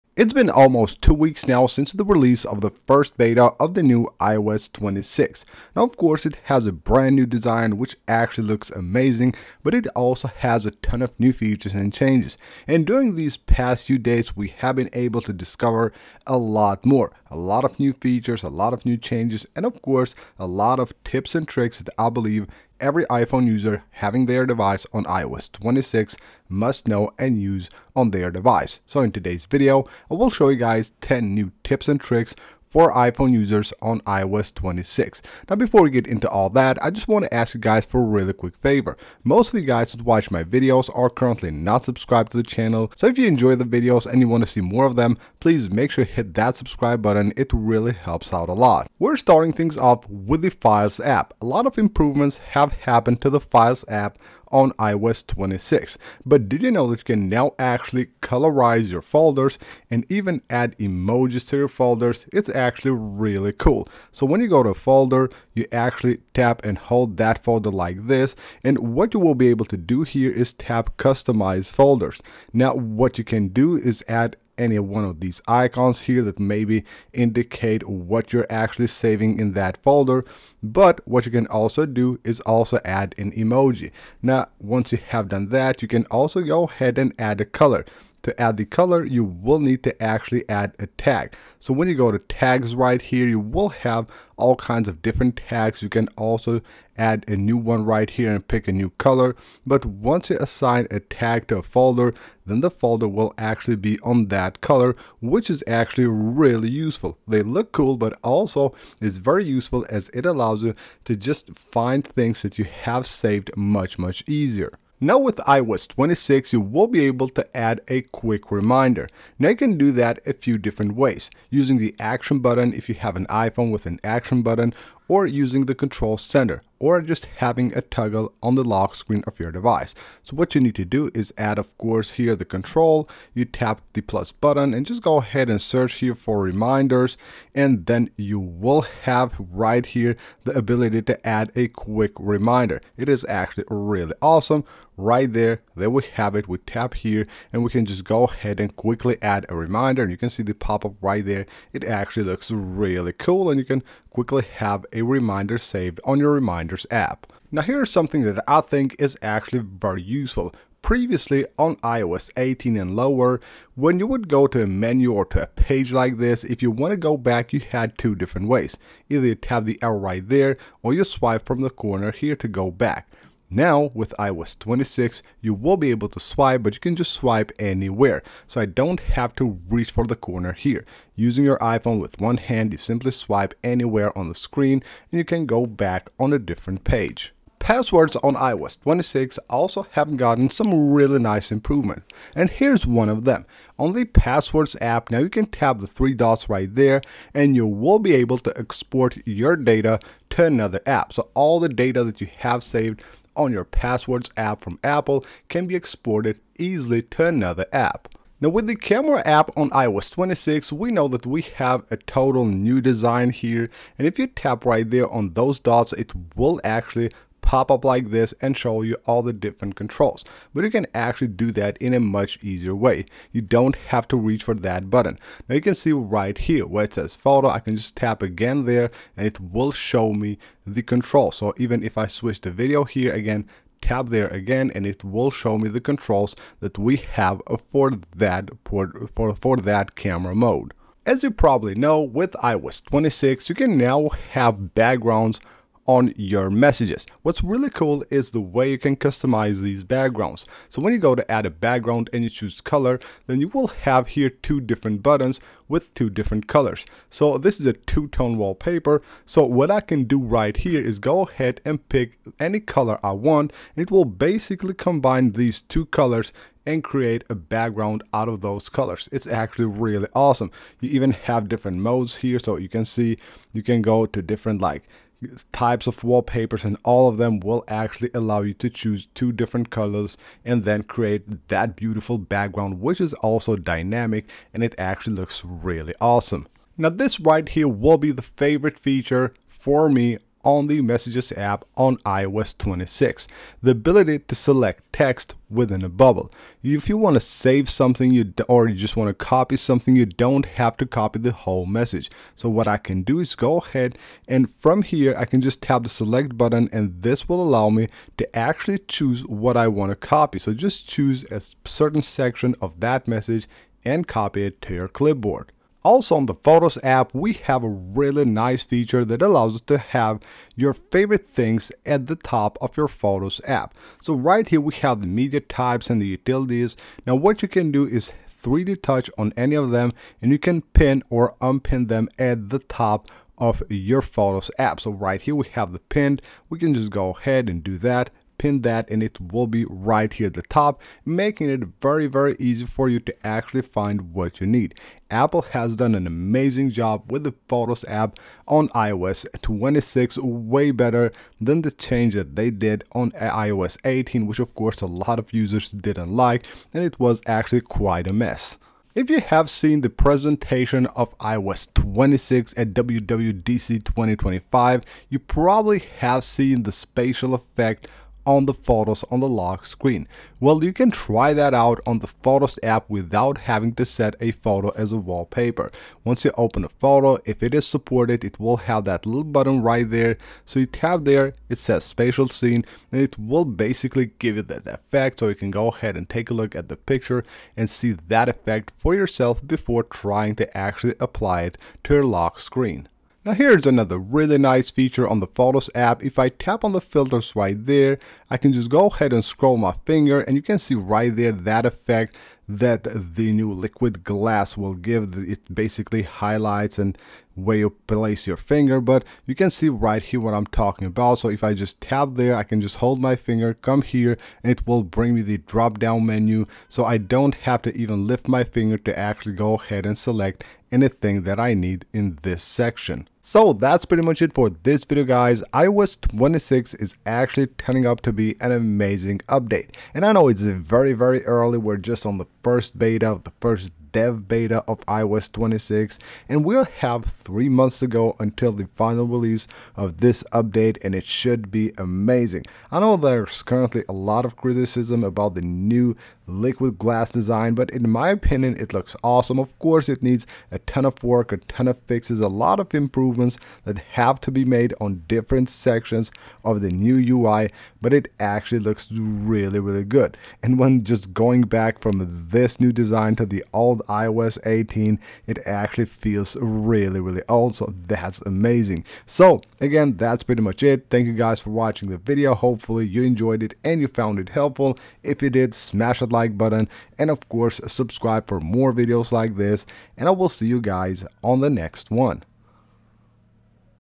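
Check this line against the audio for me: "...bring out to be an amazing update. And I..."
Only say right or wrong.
wrong.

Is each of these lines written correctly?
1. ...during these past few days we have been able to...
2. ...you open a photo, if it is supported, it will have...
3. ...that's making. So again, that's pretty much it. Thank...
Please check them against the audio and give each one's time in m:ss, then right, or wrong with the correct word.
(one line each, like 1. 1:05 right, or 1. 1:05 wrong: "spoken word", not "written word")
1. 0:12 right
2. 6:16 right
3. 7:47 wrong: "amazing", not "making".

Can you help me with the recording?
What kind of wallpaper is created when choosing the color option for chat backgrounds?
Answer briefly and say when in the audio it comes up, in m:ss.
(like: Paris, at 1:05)
Two-tone wallpaper, at 4:17.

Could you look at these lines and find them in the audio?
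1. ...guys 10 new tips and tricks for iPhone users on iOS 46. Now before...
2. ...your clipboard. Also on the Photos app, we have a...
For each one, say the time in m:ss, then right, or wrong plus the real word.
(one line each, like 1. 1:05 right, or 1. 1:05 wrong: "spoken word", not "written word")
1. 0:30 wrong: "26", not "46"
2. 5:14 right.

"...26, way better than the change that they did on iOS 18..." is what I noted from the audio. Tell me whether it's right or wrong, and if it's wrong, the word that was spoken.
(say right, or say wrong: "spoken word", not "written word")
right.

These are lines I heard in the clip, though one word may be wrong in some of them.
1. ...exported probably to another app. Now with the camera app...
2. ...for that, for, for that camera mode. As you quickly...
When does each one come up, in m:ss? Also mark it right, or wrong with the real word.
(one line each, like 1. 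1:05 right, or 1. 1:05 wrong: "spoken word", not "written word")
1. 3:25 wrong: "easily", not "probably"
2. 3:57 wrong: "probably", not "quickly".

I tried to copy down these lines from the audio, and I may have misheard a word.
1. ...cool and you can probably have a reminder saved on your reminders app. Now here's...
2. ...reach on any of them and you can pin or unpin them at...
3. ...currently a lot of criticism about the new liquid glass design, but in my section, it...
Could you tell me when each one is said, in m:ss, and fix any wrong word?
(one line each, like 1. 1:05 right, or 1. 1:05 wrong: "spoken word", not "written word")
1. 2:33 wrong: "quickly", not "probably"
2. 5:28 wrong: "touch", not "reach"
3. 7:23 wrong: "opinion", not "section".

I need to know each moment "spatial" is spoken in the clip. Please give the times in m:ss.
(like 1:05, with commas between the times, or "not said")
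6:06, 6:21.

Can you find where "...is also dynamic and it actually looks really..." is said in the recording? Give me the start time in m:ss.
4:42.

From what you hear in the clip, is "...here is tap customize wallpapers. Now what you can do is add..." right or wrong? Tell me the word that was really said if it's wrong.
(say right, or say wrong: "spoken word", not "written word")
wrong: "folders", not "wallpapers".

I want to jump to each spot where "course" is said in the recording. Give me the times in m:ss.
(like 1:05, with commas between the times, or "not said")
0:05, 0:19, 2:11, 5:54, 7:29, 7:57.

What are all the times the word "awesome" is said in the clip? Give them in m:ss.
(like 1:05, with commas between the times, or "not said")
2:24, 4:30, 4:46, 7:29.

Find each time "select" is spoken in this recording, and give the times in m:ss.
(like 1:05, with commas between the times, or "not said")
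4:54, 5:05, 6:59.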